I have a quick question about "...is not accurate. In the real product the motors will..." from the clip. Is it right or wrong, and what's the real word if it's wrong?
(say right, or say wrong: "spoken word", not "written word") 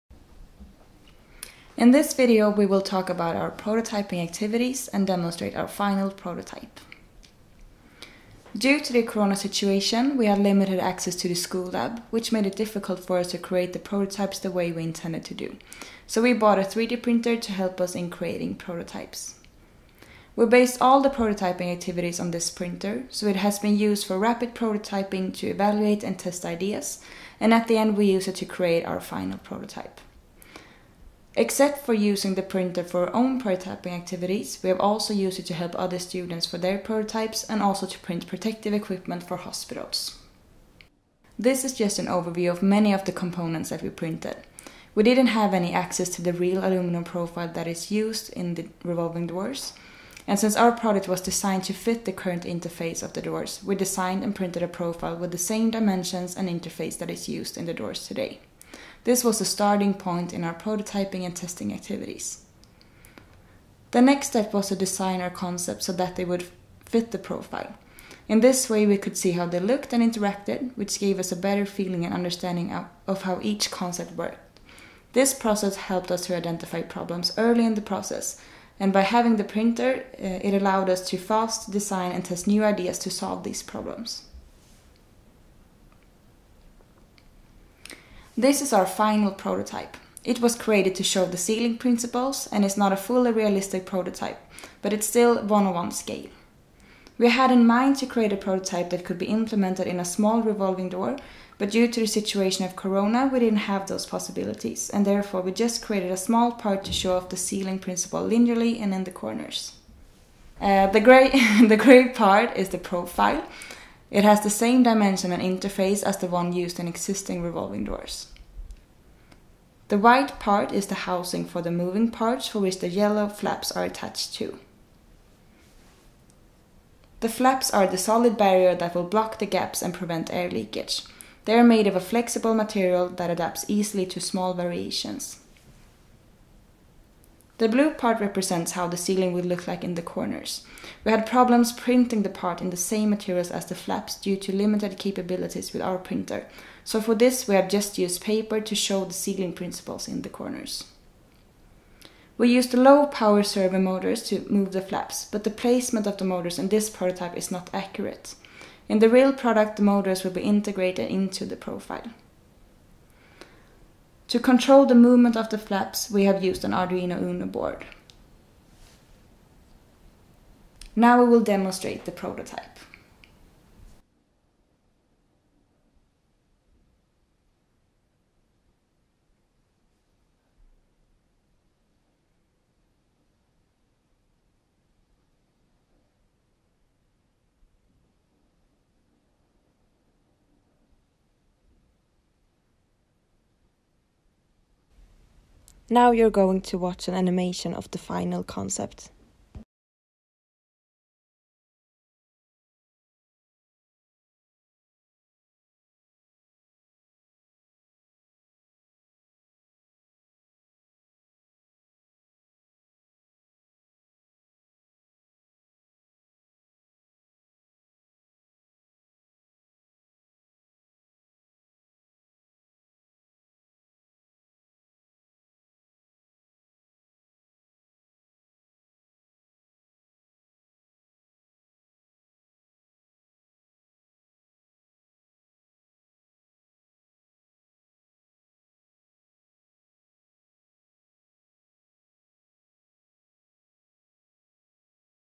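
right.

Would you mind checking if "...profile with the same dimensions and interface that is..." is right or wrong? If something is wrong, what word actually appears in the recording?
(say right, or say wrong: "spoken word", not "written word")
right.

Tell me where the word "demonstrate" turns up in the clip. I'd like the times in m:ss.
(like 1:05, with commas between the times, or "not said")
0:05, 2:51.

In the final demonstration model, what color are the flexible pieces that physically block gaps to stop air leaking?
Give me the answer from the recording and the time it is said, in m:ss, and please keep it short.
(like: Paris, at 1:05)
yellow, at 2:02.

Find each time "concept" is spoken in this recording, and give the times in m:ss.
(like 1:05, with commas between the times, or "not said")
1:05, 1:13, 3:18.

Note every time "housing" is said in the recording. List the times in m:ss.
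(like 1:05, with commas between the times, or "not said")
2:01.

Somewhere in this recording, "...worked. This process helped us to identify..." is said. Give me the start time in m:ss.
1:14.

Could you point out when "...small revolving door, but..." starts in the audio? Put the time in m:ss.
1:40.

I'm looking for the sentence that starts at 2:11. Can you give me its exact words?
They are made of a flexible material that adapts easily to small variations.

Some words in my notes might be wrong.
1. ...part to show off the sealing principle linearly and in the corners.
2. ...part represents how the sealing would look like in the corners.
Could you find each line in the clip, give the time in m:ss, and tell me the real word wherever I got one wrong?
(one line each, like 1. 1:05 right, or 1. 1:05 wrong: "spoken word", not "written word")
1. 1:46 right
2. 2:17 right.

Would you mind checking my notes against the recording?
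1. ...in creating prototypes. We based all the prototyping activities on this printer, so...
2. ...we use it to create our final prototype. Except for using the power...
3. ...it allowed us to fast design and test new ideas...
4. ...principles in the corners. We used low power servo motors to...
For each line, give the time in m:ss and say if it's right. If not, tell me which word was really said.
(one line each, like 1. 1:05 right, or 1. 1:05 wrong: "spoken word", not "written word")
1. 0:17 right
2. 0:27 wrong: "printer", not "power"
3. 1:20 right
4. 2:29 right.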